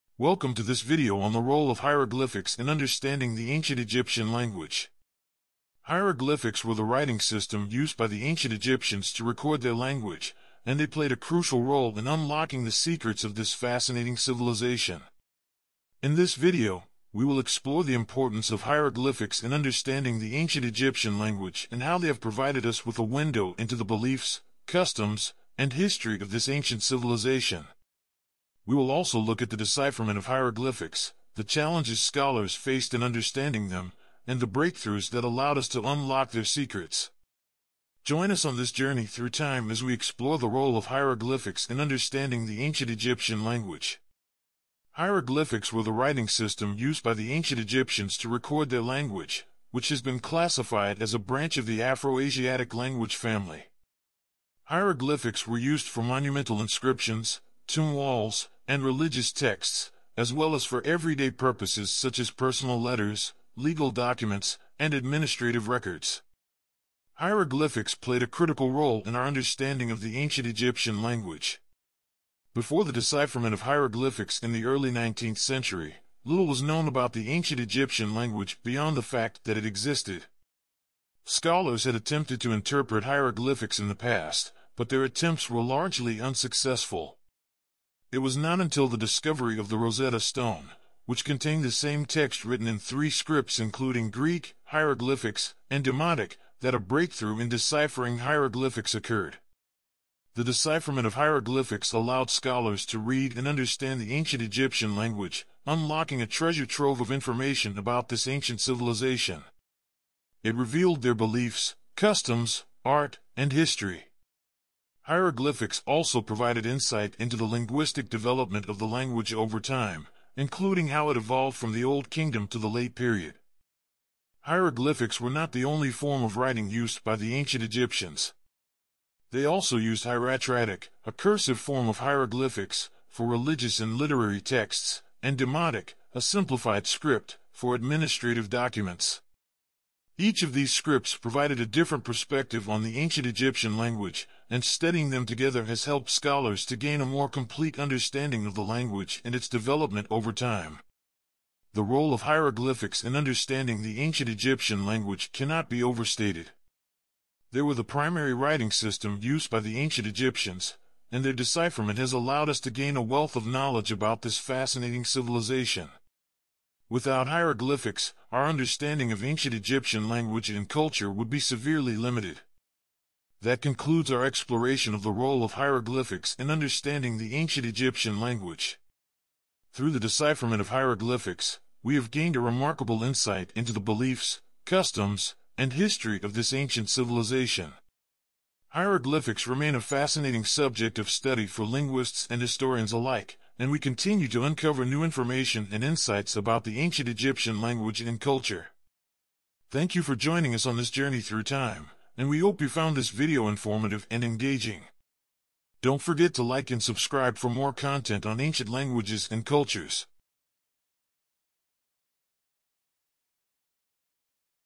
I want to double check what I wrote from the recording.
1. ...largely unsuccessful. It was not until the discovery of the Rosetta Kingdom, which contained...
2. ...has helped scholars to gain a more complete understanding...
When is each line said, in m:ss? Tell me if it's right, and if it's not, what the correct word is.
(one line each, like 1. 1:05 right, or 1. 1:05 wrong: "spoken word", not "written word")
1. 1:25 wrong: "Stone", not "Kingdom"
2. 2:25 right.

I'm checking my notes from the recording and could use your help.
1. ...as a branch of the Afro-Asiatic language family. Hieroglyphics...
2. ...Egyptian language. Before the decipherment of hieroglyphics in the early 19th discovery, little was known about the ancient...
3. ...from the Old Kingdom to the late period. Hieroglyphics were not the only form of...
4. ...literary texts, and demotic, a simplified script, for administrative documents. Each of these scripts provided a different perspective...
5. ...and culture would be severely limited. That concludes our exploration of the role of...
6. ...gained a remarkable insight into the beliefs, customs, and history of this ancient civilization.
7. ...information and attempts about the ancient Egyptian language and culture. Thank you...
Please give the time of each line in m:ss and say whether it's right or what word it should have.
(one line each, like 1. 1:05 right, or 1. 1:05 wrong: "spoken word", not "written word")
1. 0:51 right
2. 1:10 wrong: "century", not "discovery"
3. 2:01 right
4. 2:13 right
5. 2:50 right
6. 3:02 right
7. 3:15 wrong: "insights", not "attempts".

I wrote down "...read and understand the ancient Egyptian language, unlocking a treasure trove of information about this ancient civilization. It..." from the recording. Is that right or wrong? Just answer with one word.
right.